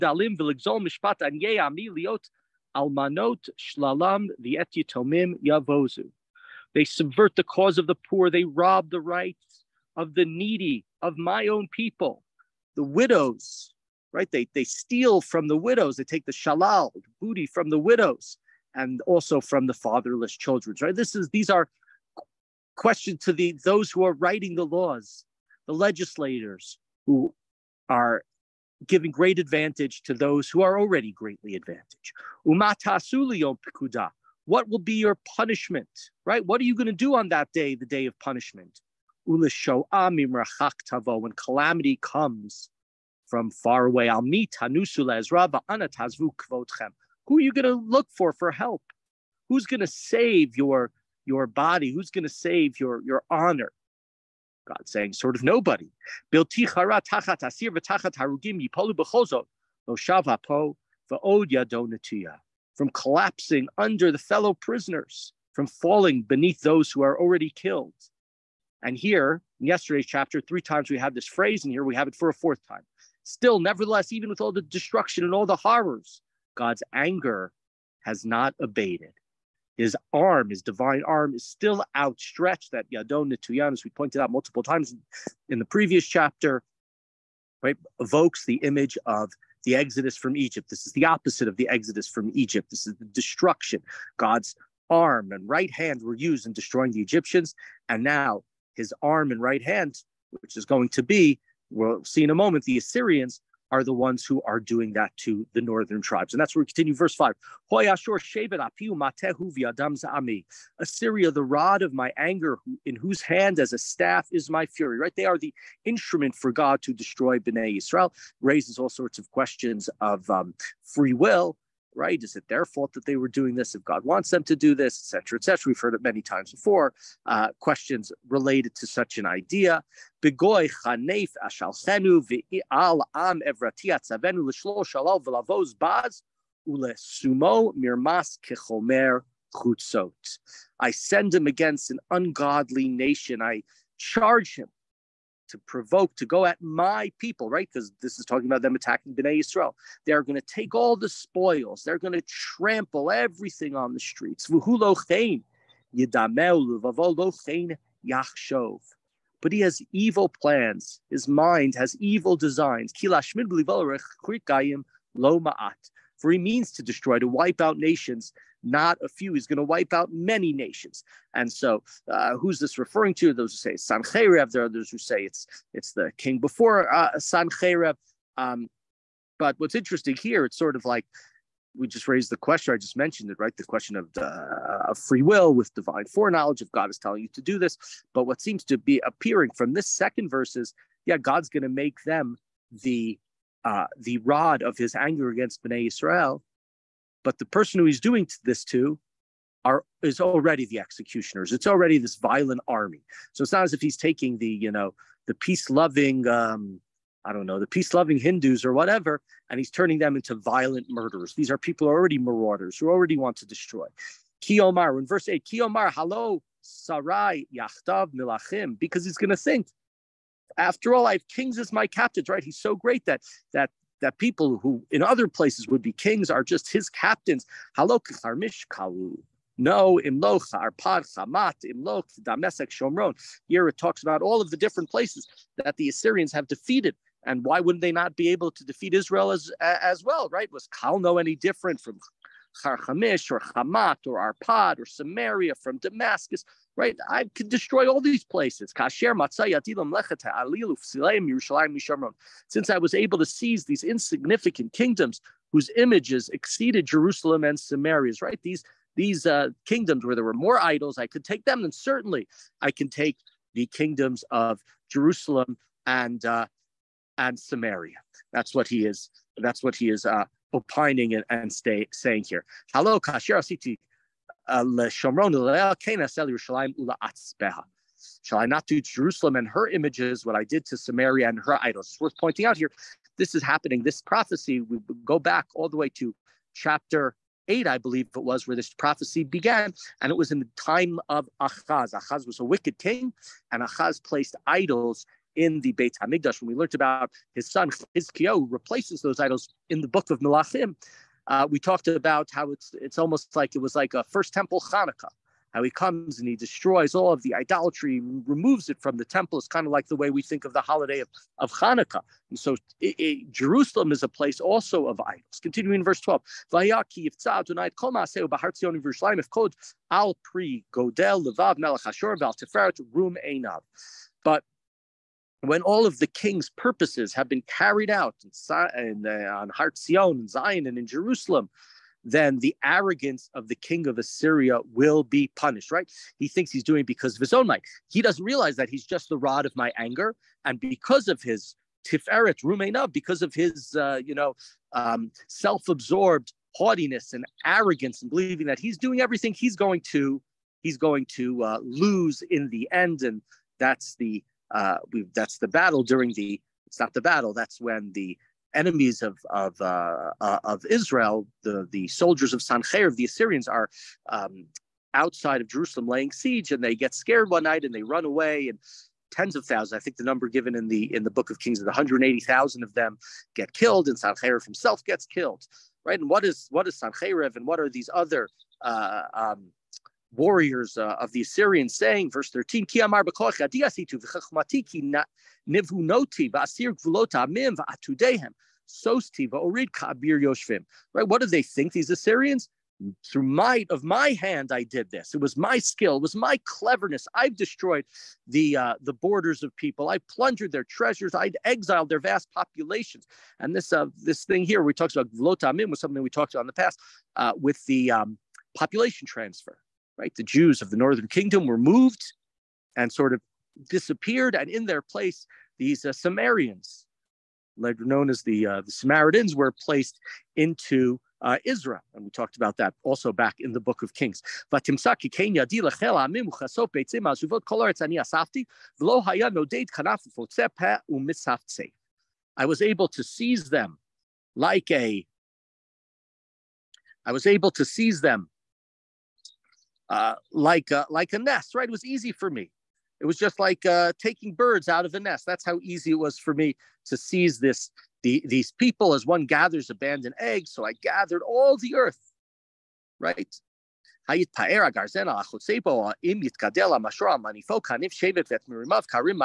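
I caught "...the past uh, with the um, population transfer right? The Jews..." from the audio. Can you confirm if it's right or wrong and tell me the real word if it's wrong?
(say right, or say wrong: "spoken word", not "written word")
right.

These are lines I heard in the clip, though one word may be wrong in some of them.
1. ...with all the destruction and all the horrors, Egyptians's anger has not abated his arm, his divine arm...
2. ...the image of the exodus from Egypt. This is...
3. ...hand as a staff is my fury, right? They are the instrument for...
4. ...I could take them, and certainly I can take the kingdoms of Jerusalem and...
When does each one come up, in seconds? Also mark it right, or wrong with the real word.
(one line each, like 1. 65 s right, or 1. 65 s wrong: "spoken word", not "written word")
1. 74 s wrong: "God", not "Egyptians"
2. 88 s right
3. 113 s right
4. 260 s right.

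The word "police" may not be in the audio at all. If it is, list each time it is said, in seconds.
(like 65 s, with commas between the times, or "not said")
not said.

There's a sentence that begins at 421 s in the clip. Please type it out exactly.
And we talked about that also back in the book of Kings.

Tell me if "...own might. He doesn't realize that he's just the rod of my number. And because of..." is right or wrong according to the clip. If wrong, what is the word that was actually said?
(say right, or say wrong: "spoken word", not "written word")
wrong: "anger", not "number".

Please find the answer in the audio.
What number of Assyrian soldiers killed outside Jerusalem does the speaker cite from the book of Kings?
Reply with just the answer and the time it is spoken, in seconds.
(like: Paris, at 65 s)
180,000, at 371 s.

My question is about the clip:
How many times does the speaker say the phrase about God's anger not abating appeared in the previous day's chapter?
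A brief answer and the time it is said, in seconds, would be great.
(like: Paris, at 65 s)
3, at 70 s.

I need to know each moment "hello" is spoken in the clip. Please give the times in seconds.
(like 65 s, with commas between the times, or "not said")
215 s, 272 s.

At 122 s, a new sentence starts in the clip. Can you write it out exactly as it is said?
Is it their fault that they were doing this?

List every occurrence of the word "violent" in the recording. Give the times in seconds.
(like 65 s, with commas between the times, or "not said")
202 s, 210 s.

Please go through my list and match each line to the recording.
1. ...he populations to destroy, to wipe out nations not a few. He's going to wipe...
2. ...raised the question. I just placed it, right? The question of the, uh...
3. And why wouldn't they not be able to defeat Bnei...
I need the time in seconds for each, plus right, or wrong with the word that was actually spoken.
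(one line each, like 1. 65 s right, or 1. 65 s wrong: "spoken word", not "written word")
1. 166 s wrong: "means", not "populations"
2. 182 s wrong: "mentioned", not "placed"
3. 237 s wrong: "Israel", not "Bnei".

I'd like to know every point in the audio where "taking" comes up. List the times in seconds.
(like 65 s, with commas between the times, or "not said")
203 s, 444 s.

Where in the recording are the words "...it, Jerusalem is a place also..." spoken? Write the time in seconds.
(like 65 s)
312 s.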